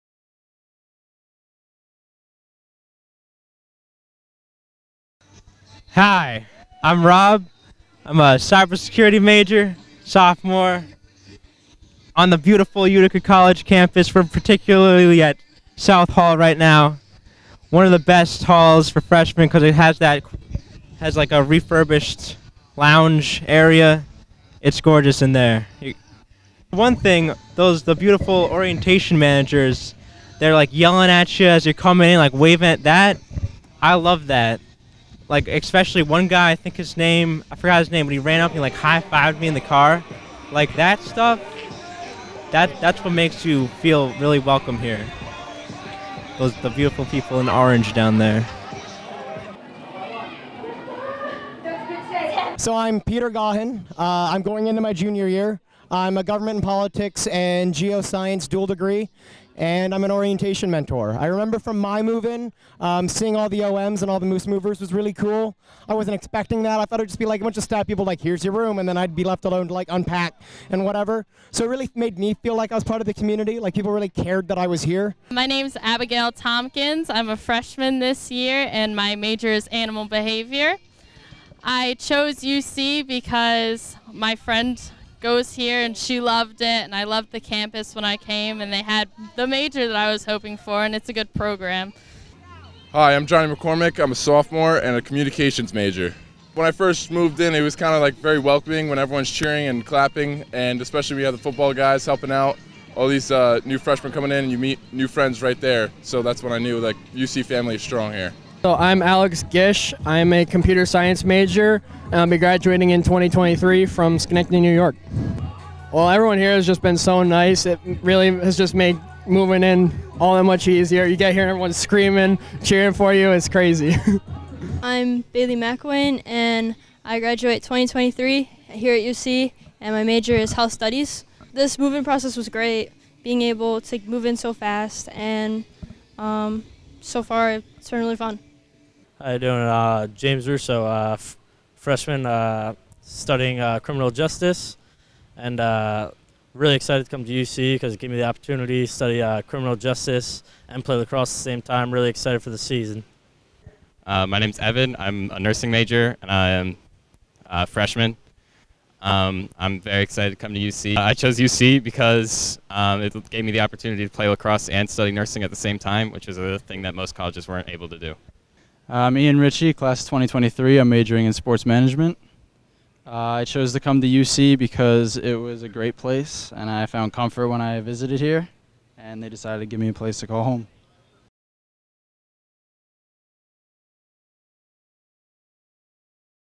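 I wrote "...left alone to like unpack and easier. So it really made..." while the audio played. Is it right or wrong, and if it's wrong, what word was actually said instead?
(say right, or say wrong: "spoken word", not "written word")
wrong: "whatever", not "easier".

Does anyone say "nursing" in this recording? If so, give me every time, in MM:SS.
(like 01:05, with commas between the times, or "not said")
02:35, 02:45.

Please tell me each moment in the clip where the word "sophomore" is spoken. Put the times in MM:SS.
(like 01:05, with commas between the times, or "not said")
00:10, 01:34.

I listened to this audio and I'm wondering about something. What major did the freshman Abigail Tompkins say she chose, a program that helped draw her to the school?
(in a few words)
Animal behavior.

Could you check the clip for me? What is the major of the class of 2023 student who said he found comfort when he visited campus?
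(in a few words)
Sports management.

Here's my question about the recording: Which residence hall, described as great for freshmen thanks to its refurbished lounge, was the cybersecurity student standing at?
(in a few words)
South Hall.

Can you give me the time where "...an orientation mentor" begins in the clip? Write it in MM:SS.
01:00.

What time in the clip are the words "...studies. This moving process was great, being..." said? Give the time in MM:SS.
02:10.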